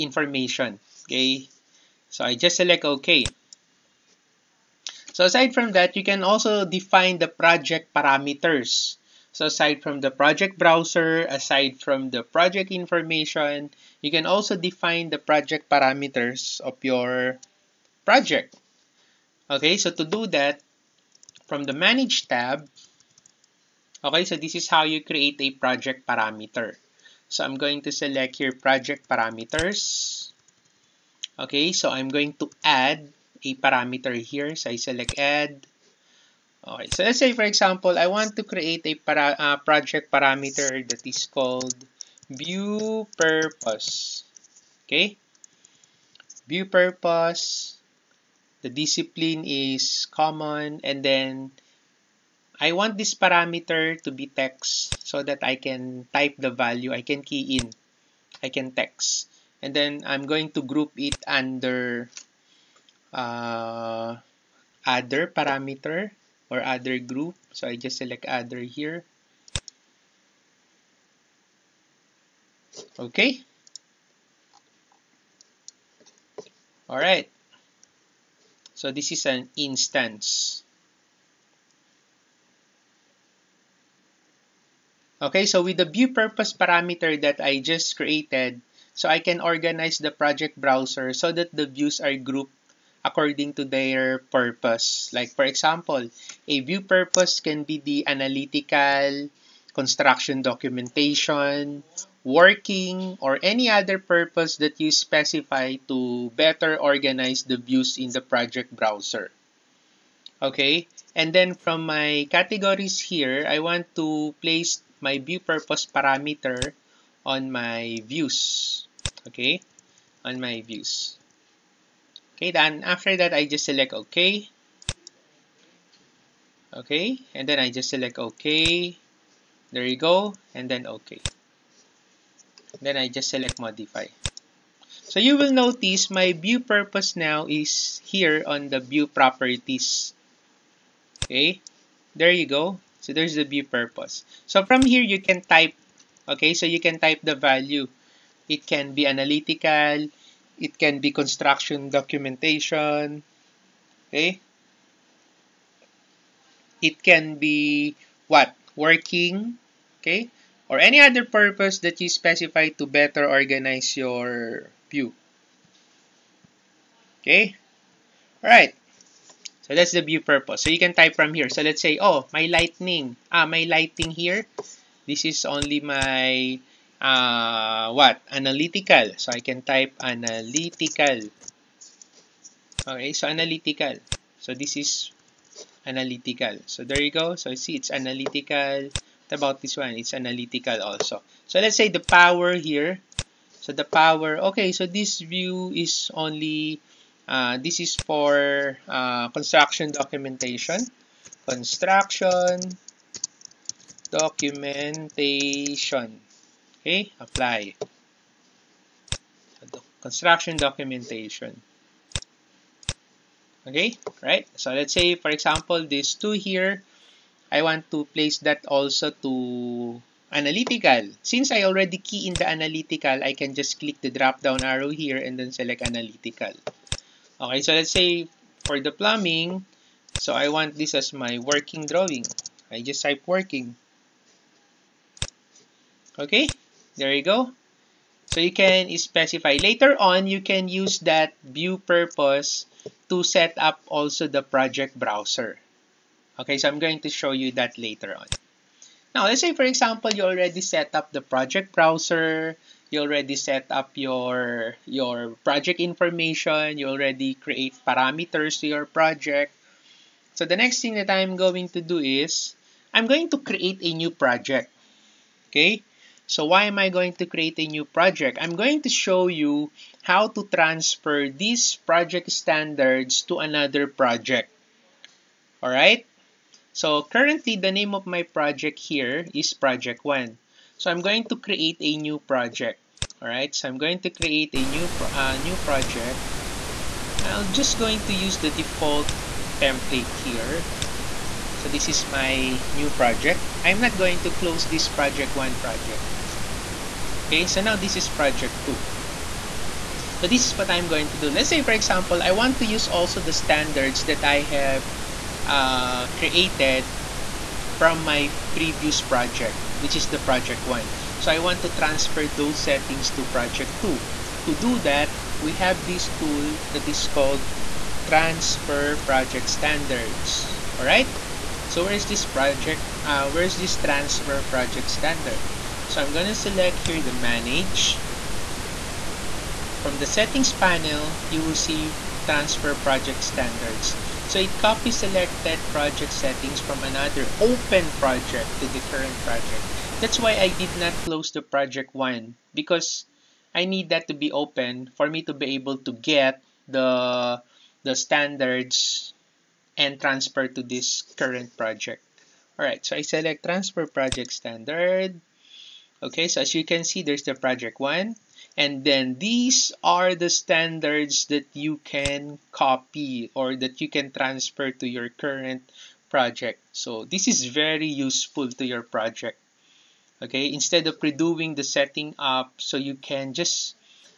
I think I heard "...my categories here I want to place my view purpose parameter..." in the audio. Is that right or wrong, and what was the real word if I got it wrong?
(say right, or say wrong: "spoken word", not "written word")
right.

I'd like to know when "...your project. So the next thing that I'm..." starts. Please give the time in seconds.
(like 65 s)
258 s.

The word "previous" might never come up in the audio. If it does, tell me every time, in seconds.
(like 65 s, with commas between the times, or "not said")
308 s.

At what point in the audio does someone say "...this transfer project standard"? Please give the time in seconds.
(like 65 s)
323 s.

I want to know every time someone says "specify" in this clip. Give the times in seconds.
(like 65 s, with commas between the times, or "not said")
104 s, 162 s, 238 s.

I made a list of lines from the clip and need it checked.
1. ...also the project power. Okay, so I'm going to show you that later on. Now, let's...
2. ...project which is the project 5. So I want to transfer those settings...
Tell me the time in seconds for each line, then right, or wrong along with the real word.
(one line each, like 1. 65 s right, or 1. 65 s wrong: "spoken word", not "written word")
1. 243 s wrong: "browser", not "power"
2. 309 s wrong: "1", not "5".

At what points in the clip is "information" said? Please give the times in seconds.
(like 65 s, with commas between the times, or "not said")
0 s, 12 s, 255 s.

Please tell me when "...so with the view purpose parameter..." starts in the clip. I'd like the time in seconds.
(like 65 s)
85 s.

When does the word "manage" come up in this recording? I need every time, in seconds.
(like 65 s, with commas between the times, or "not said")
21 s, 327 s.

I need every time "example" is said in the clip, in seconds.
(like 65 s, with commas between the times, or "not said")
37 s, 95 s, 215 s, 249 s, 301 s.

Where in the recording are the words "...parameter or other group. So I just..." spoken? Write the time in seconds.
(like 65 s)
65 s.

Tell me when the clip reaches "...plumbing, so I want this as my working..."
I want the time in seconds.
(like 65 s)
228 s.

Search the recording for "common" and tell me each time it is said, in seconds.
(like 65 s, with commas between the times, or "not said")
50 s.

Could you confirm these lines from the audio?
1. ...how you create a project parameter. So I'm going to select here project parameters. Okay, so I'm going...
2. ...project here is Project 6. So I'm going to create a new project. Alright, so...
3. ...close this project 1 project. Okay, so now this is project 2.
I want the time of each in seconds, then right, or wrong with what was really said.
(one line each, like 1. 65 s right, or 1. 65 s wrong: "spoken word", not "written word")
1. 24 s right
2. 278 s wrong: "1", not "6"
3. 294 s right.